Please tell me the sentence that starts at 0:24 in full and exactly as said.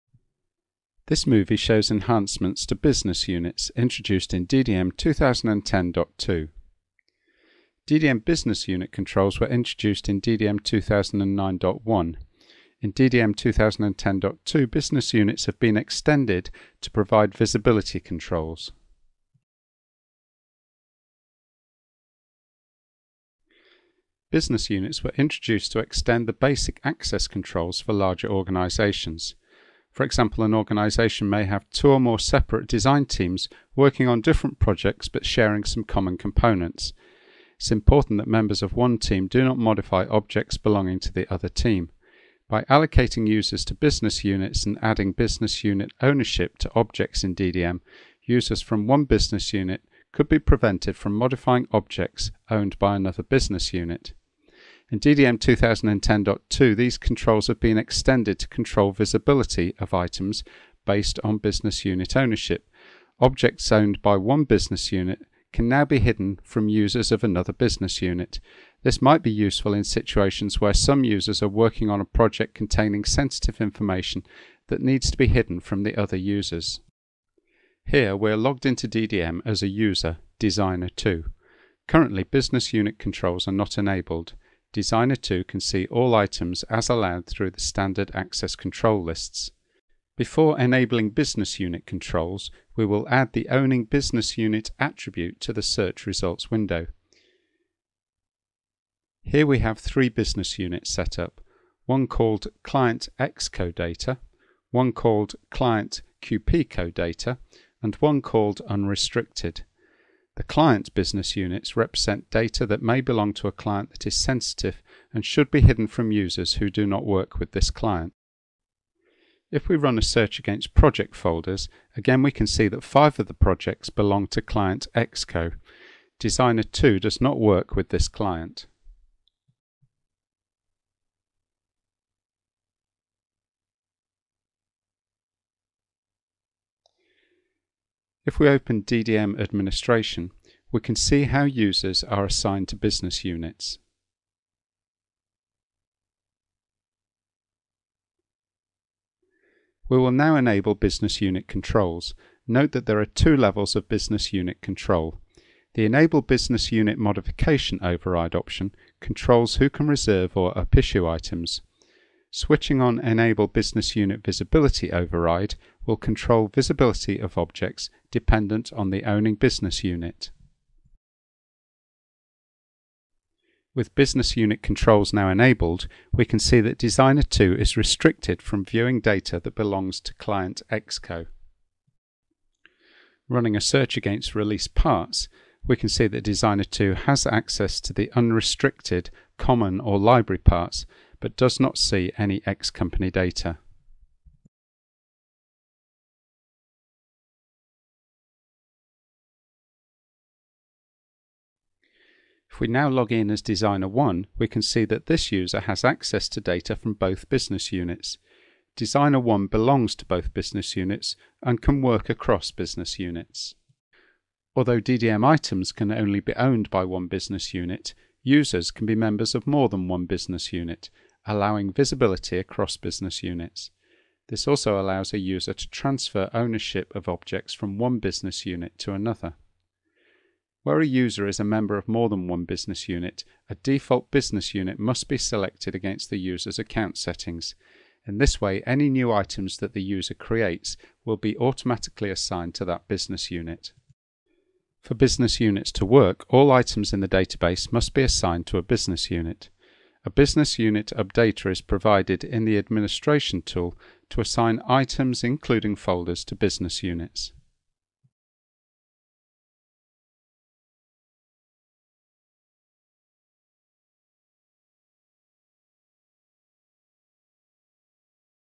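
Business units were introduced to extend the basic access controls for larger organizations.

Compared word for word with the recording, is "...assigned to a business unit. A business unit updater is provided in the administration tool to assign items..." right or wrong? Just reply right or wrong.
right.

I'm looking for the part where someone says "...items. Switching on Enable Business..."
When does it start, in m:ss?
2:41.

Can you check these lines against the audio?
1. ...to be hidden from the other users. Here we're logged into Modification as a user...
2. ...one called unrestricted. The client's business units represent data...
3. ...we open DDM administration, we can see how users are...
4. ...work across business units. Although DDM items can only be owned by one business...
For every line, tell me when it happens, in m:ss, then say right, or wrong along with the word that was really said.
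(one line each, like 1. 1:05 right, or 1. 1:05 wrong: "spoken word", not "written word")
1. 1:15 wrong: "DDM", not "Modification"
2. 1:47 right
3. 2:18 right
4. 3:31 right.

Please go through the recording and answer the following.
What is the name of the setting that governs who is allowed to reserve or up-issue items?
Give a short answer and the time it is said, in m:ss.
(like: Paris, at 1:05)
Enable Business Unit Modification Override, at 2:35.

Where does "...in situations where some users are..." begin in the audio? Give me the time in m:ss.
1:09.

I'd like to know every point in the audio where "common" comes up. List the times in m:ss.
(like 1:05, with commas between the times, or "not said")
0:35, 3:09.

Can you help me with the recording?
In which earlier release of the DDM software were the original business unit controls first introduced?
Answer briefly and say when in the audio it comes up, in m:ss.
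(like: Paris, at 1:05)
DDM 2009.1, at 0:10.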